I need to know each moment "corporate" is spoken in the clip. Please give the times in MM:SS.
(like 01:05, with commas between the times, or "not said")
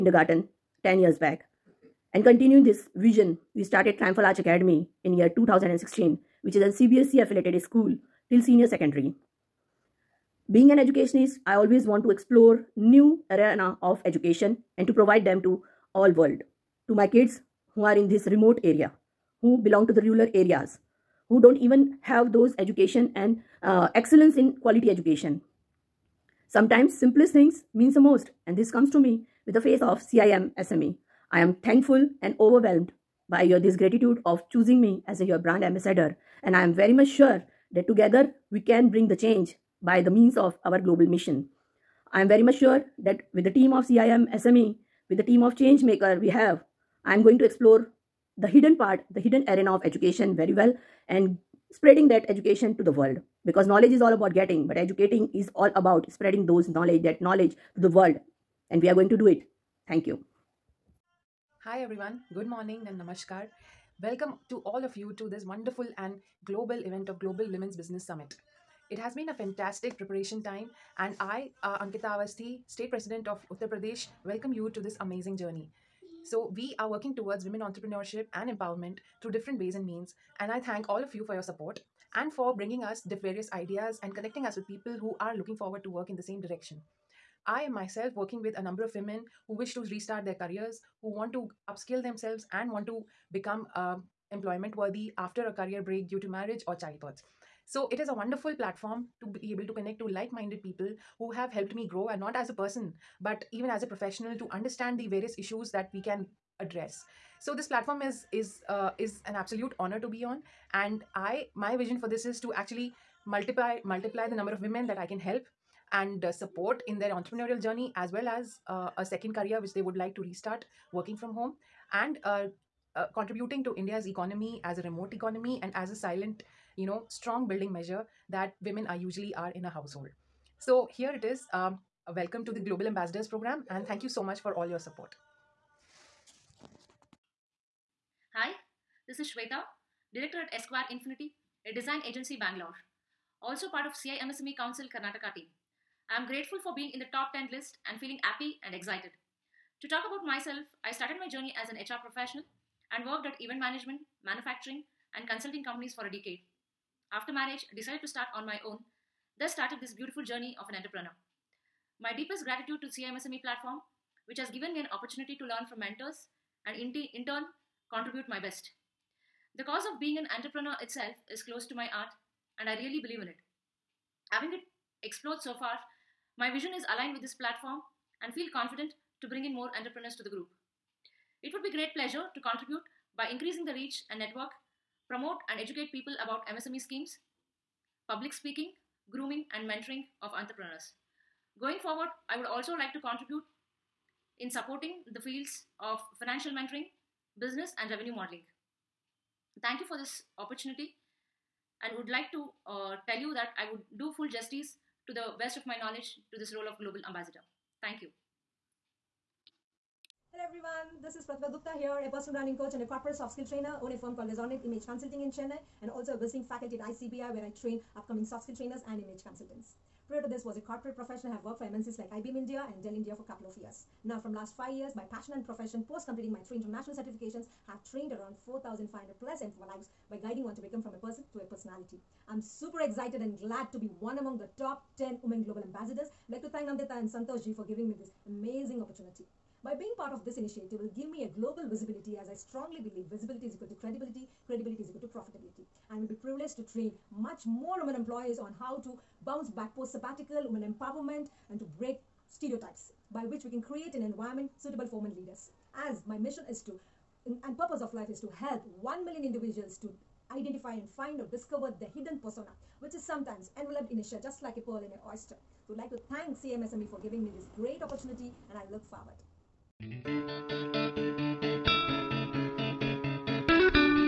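03:32, 03:40.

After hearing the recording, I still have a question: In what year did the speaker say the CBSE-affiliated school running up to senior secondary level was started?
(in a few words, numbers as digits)
2016.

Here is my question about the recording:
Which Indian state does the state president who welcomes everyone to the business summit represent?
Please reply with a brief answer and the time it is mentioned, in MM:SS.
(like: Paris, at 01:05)
Uttar Pradesh, at 01:13.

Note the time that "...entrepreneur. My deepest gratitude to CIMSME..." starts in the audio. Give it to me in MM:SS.
02:40.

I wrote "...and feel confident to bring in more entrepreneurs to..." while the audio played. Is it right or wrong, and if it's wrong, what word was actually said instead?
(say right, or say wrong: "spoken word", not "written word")
right.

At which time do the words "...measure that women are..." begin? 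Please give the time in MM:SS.
02:07.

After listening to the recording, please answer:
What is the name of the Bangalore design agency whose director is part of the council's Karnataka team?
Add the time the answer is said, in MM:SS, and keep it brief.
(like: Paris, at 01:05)
Esquire Infinity, at 02:20.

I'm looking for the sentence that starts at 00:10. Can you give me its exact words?
Being an educationist, I always want to explore new arena of education and to provide them to all world.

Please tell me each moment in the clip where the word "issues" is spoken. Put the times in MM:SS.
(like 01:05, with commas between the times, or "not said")
01:45.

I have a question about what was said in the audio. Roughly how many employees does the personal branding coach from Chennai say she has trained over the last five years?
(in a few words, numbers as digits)
4,500+.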